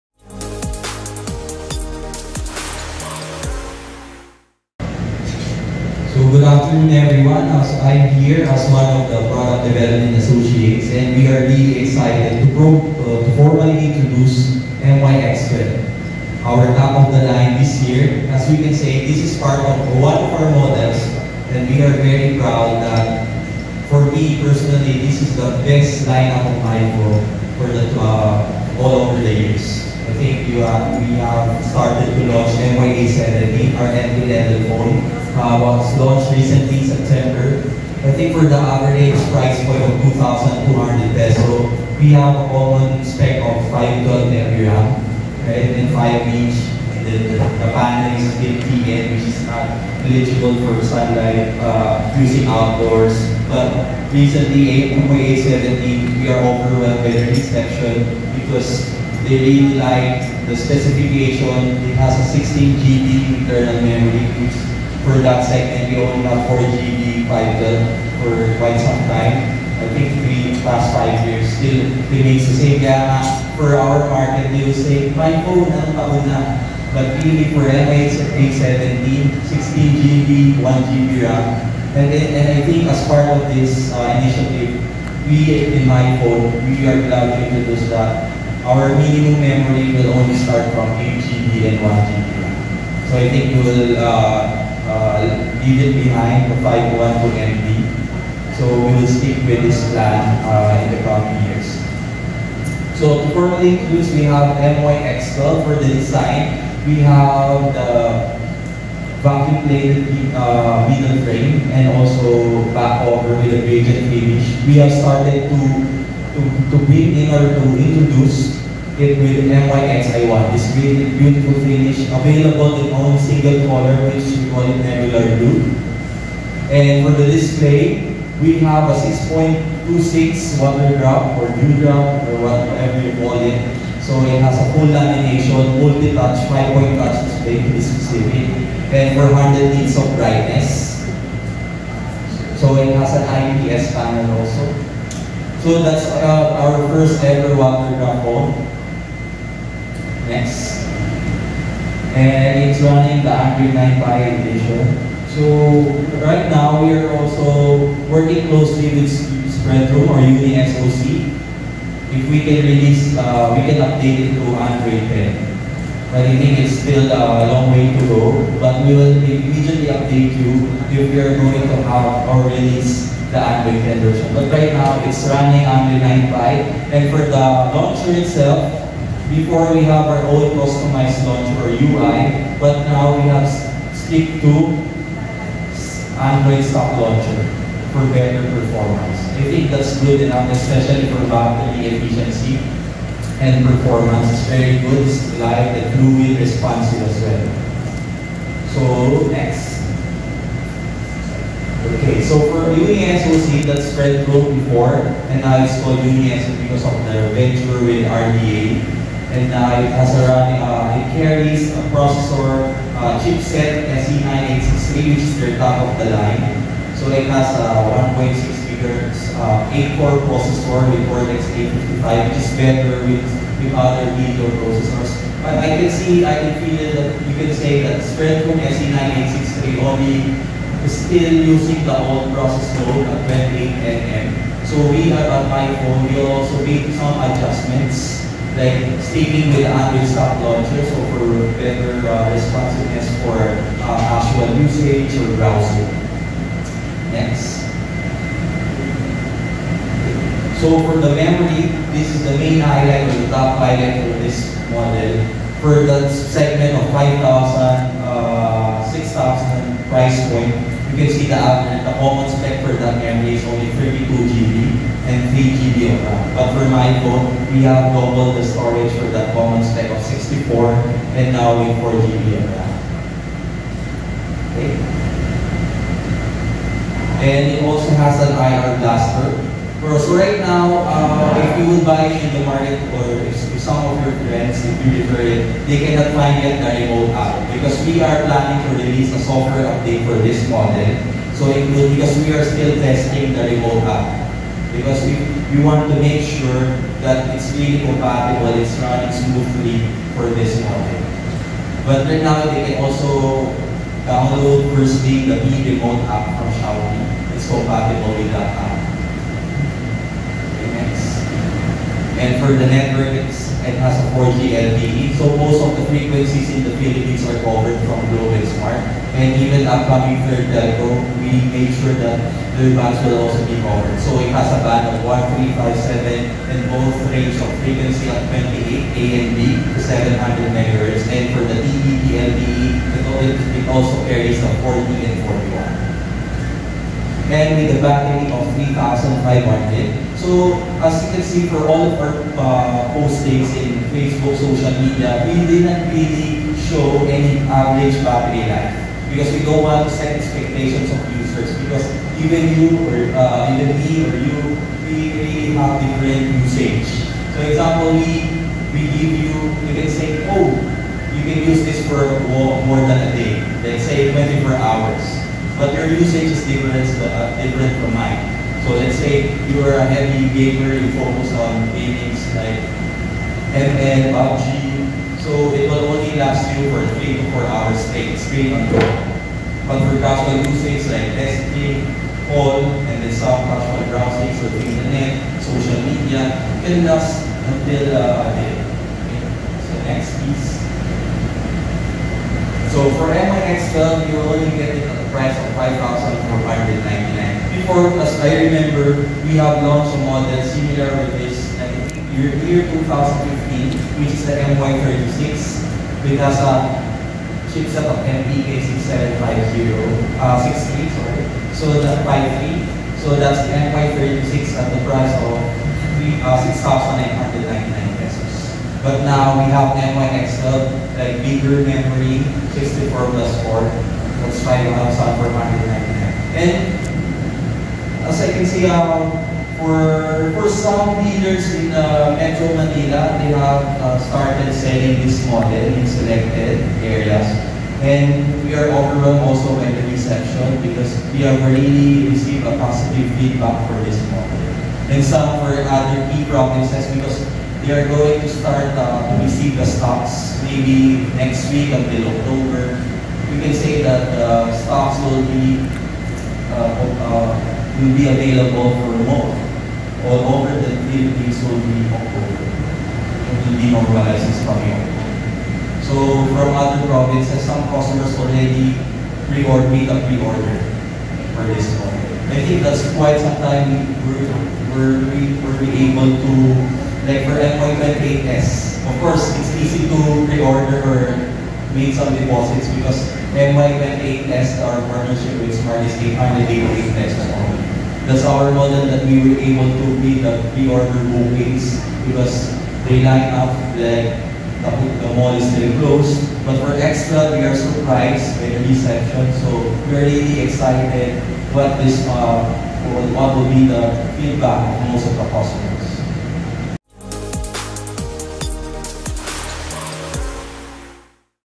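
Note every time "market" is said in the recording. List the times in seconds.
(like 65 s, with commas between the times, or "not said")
74 s, 282 s.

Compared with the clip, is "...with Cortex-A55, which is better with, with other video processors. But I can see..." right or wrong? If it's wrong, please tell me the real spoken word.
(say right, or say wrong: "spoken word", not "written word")
right.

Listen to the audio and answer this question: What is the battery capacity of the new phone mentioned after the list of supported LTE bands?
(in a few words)
3,500.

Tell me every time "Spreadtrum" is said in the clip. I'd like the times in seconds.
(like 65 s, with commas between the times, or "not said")
159 s, 203 s, 228 s.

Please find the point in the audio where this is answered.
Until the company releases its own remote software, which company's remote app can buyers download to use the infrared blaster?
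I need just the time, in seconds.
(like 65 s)
306 s.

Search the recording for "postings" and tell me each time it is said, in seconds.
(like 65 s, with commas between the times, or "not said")
342 s.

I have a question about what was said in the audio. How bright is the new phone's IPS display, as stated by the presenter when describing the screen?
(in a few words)
400 nits.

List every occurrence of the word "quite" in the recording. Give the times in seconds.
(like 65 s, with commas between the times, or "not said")
68 s, 472 s.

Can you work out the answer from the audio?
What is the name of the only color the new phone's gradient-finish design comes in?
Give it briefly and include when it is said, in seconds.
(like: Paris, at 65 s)
Nebular Blue, at 124 s.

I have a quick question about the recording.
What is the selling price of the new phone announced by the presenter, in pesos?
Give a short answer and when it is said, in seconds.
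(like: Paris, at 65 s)
5,499, at 395 s.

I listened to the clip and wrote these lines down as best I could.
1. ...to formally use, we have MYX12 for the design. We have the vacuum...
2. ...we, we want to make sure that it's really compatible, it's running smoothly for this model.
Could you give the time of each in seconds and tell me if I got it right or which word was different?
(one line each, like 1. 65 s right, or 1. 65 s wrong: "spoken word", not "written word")
1. 103 s right
2. 295 s right.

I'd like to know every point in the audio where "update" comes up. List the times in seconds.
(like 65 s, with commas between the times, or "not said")
163 s, 169 s, 289 s.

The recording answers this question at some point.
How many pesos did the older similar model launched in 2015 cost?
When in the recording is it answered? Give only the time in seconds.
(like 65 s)
416 s.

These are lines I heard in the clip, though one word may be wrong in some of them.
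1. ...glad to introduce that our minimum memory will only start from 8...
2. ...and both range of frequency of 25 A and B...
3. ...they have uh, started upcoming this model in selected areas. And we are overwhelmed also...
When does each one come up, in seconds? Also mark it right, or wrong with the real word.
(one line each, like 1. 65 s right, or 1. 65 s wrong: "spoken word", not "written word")
1. 87 s right
2. 326 s wrong: "28", not "25"
3. 433 s wrong: "selling", not "upcoming".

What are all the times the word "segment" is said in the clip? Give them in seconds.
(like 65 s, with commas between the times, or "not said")
65 s, 256 s.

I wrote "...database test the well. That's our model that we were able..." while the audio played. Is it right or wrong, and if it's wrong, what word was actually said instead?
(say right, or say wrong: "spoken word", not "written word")
right.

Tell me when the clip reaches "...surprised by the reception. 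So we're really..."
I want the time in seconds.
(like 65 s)
497 s.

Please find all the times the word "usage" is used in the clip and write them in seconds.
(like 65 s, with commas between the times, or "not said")
244 s, 356 s, 365 s, 380 s.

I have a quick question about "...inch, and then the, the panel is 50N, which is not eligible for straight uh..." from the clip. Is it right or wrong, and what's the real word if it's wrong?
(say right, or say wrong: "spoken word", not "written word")
wrong: "sunlight", not "straight".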